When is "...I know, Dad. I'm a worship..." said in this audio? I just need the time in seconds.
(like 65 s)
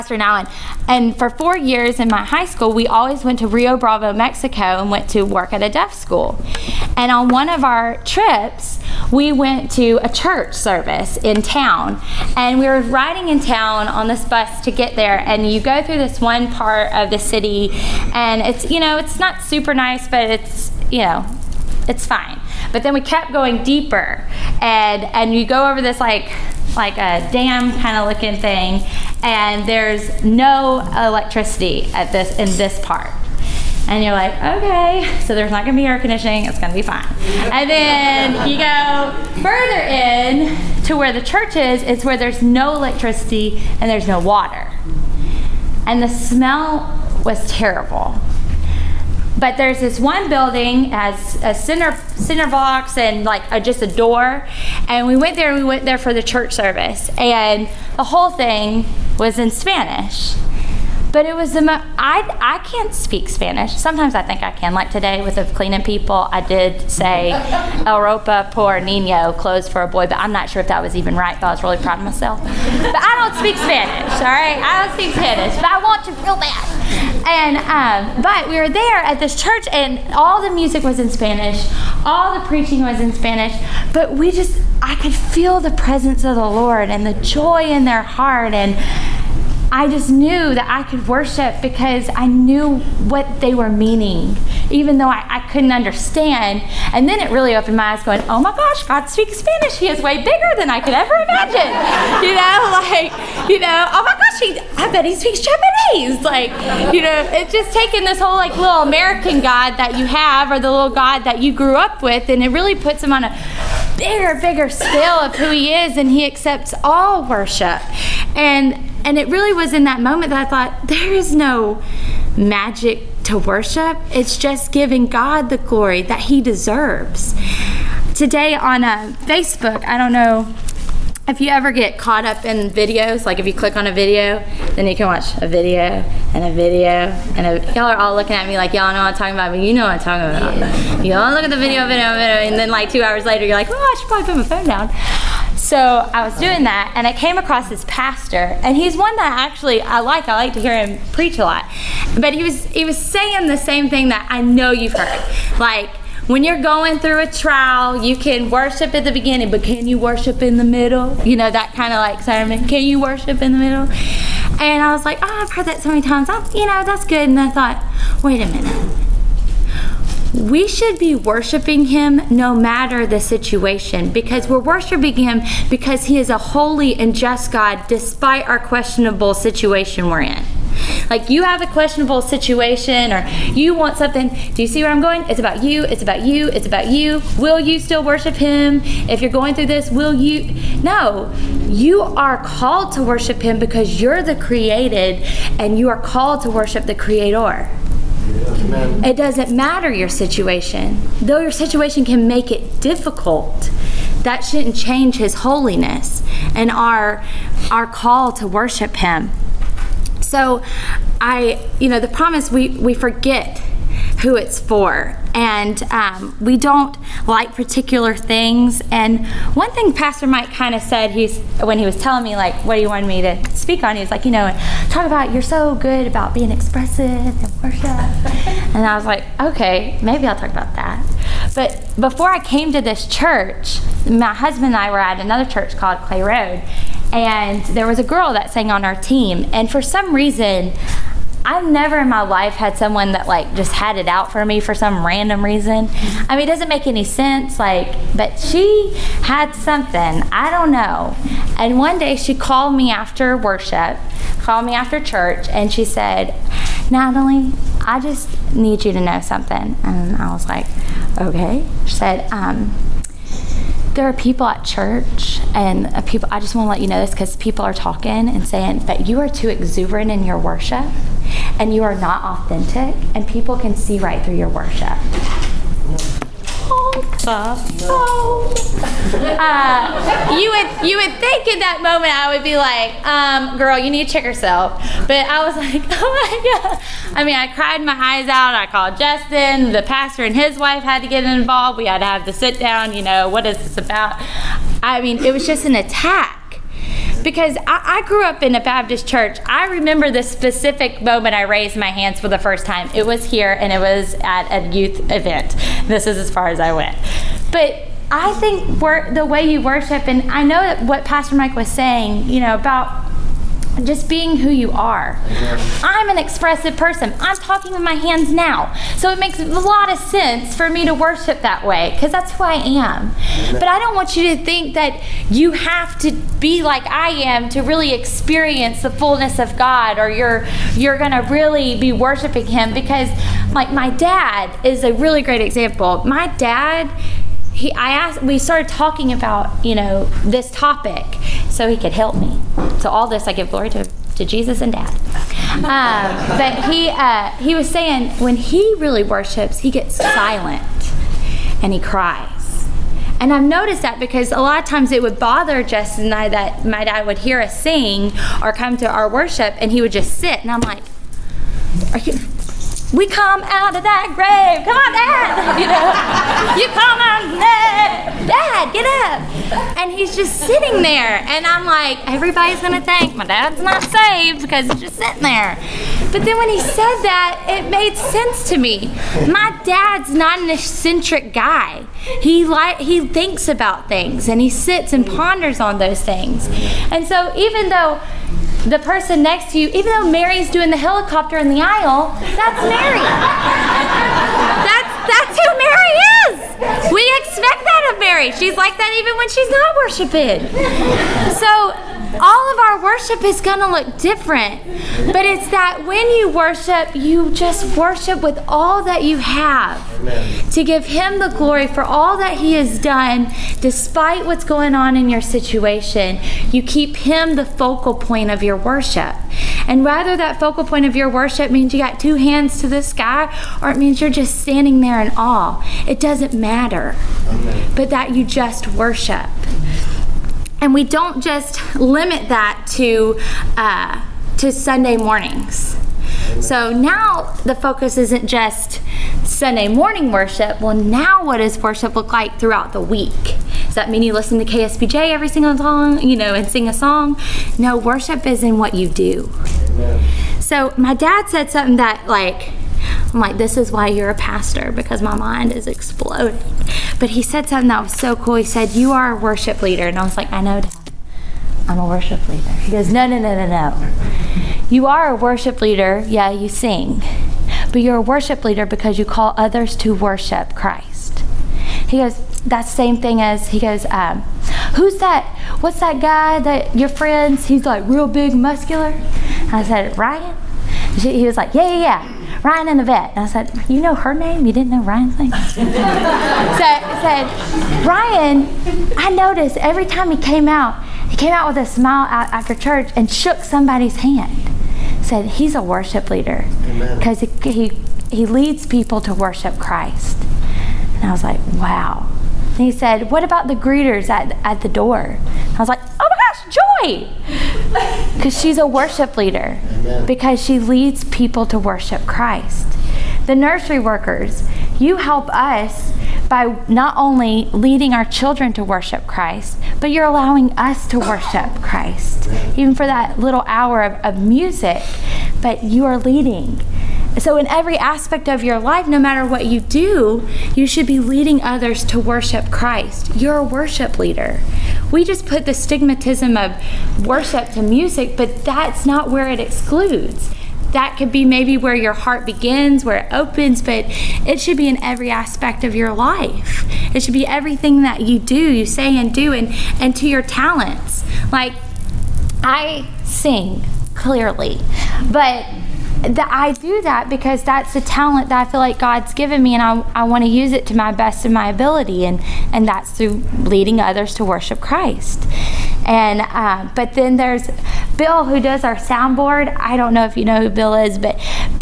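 460 s.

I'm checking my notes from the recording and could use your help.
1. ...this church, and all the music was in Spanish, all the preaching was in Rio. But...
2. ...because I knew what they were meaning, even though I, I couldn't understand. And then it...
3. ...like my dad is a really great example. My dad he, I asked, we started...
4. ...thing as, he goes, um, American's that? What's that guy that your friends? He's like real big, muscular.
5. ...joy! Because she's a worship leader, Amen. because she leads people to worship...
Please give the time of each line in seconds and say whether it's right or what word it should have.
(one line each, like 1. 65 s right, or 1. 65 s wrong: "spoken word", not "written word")
1. 79 s wrong: "Spanish", not "Rio"
2. 91 s right
3. 333 s right
4. 472 s wrong: "Who", not "American"
5. 506 s right.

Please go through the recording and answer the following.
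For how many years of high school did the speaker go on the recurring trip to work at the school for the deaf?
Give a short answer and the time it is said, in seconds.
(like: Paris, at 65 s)
4, at 1 s.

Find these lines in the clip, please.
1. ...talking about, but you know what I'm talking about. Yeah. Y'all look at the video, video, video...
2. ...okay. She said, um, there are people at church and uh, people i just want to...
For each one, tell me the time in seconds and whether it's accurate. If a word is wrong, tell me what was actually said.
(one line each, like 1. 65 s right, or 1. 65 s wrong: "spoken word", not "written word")
1. 139 s right
2. 261 s right.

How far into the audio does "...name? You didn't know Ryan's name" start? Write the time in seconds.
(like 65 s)
484 s.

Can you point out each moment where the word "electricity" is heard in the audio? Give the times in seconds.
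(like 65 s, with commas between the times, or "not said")
30 s, 42 s.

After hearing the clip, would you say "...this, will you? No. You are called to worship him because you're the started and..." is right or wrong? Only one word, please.
wrong.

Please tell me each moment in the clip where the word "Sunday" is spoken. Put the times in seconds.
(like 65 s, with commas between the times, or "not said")
434 s, 439 s.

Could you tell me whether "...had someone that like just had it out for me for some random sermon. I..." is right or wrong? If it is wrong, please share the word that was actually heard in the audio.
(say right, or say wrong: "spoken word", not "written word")
wrong: "reason", not "sermon".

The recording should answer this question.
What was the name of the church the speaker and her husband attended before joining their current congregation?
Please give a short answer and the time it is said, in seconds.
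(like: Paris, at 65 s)
Clay Road, at 236 s.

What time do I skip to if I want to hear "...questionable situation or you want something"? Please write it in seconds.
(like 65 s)
181 s.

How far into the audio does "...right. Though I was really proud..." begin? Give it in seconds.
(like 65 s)
71 s.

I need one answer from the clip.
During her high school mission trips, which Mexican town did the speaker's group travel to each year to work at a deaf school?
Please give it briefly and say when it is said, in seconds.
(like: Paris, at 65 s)
Rio Bravo, at 3 s.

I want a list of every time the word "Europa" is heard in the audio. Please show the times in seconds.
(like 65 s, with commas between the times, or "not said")
67 s.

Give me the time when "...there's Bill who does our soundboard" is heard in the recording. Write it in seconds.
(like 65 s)
567 s.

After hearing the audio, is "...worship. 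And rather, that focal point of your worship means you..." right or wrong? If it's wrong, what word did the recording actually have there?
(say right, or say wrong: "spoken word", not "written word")
right.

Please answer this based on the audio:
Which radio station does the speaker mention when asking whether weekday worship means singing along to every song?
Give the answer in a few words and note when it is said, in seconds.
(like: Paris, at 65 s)
KSBJ, at 444 s.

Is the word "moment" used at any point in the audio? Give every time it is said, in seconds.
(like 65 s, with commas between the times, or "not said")
119 s, 281 s, 301 s.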